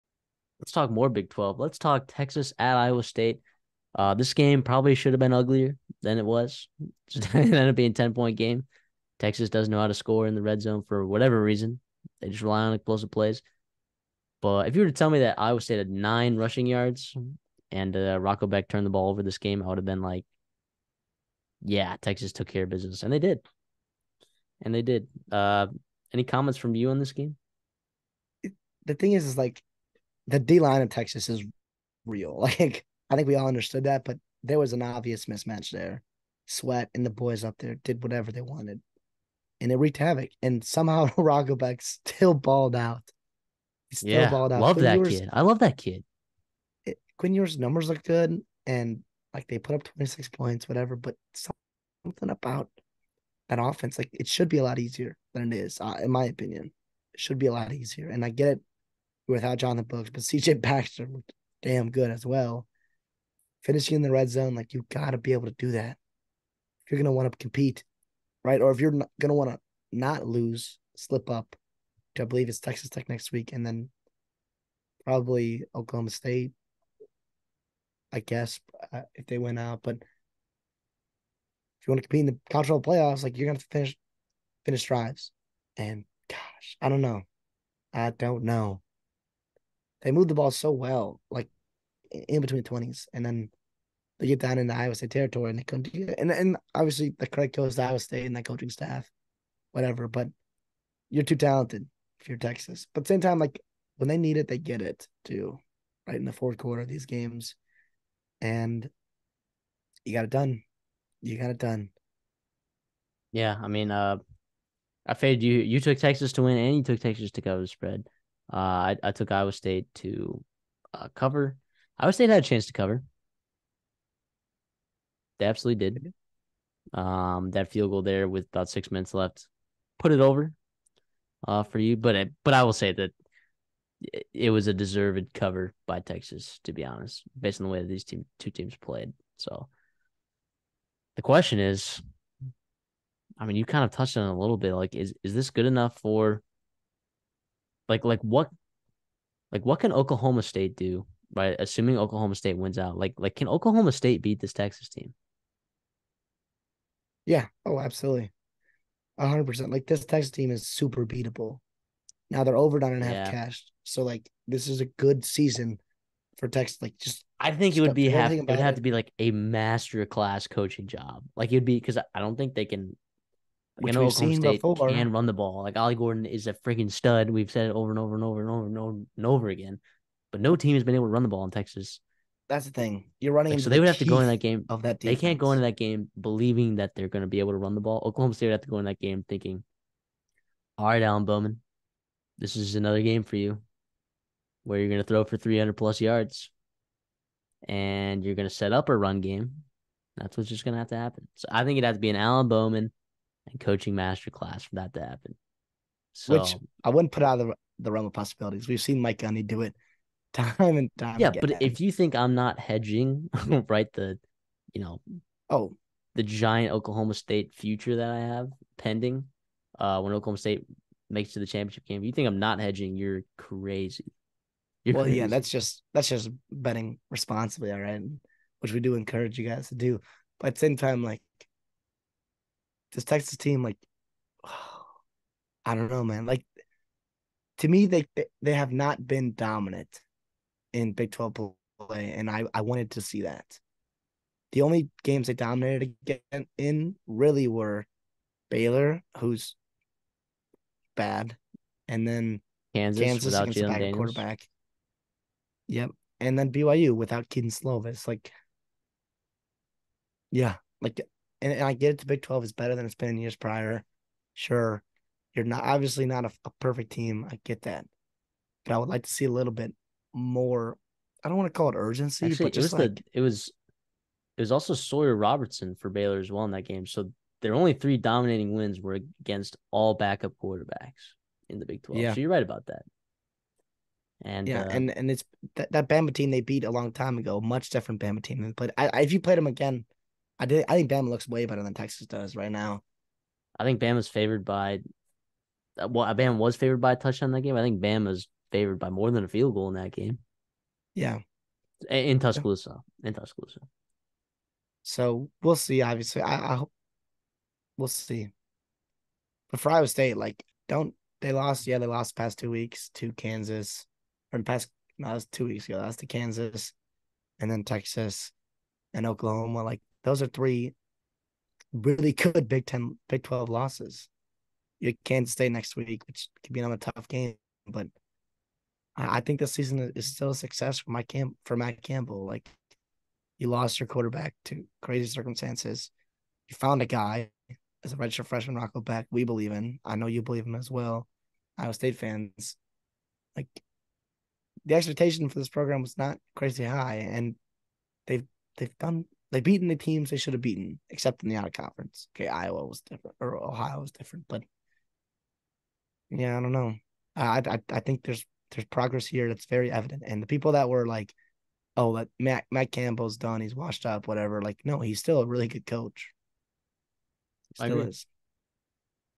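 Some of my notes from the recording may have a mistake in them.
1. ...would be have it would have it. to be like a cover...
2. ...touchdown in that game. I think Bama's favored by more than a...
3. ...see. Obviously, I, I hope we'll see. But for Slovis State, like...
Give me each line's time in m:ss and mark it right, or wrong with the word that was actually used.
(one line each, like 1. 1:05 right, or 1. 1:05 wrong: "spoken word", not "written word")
1. 2:47 wrong: "master", not "cover"
2. 4:56 right
3. 5:05 wrong: "Iowa", not "Slovis".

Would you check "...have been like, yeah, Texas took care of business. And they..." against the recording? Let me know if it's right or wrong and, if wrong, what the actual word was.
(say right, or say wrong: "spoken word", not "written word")
right.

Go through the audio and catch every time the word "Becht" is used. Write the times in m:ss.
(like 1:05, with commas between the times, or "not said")
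0:18, 0:41, 5:38.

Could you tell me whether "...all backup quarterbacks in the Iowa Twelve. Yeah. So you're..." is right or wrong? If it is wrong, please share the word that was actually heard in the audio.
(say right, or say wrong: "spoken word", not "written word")
wrong: "Big", not "Iowa".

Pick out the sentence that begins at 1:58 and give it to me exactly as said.
Uh, I, I took Iowa State to uh, cover.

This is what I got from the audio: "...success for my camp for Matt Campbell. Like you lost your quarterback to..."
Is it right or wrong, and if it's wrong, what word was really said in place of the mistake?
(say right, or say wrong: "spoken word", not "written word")
right.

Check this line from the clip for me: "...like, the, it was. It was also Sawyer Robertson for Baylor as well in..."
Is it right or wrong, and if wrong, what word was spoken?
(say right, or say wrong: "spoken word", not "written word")
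right.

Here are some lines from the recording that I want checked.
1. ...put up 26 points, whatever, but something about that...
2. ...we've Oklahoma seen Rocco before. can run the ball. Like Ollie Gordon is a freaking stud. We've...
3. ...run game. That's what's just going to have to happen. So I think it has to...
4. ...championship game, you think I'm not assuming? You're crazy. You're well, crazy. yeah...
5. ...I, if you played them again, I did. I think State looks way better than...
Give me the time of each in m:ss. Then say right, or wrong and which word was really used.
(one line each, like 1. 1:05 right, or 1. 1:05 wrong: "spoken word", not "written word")
1. 0:49 right
2. 2:54 wrong: "State", not "Rocco"
3. 3:18 right
4. 3:41 wrong: "hedging", not "assuming"
5. 4:48 wrong: "Bama", not "State".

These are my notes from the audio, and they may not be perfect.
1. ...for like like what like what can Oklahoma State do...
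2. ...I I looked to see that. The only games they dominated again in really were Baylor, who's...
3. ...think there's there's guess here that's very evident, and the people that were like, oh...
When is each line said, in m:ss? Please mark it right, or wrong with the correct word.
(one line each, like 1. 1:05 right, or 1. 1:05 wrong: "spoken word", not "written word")
1. 2:25 right
2. 4:02 wrong: "wanted", not "looked"
3. 5:57 wrong: "progress", not "guess".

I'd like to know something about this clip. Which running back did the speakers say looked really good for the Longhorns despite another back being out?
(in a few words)
CJ Baxter.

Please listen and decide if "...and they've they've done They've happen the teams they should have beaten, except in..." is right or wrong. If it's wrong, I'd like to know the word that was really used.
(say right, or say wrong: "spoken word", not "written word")
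wrong: "beaten", not "happen".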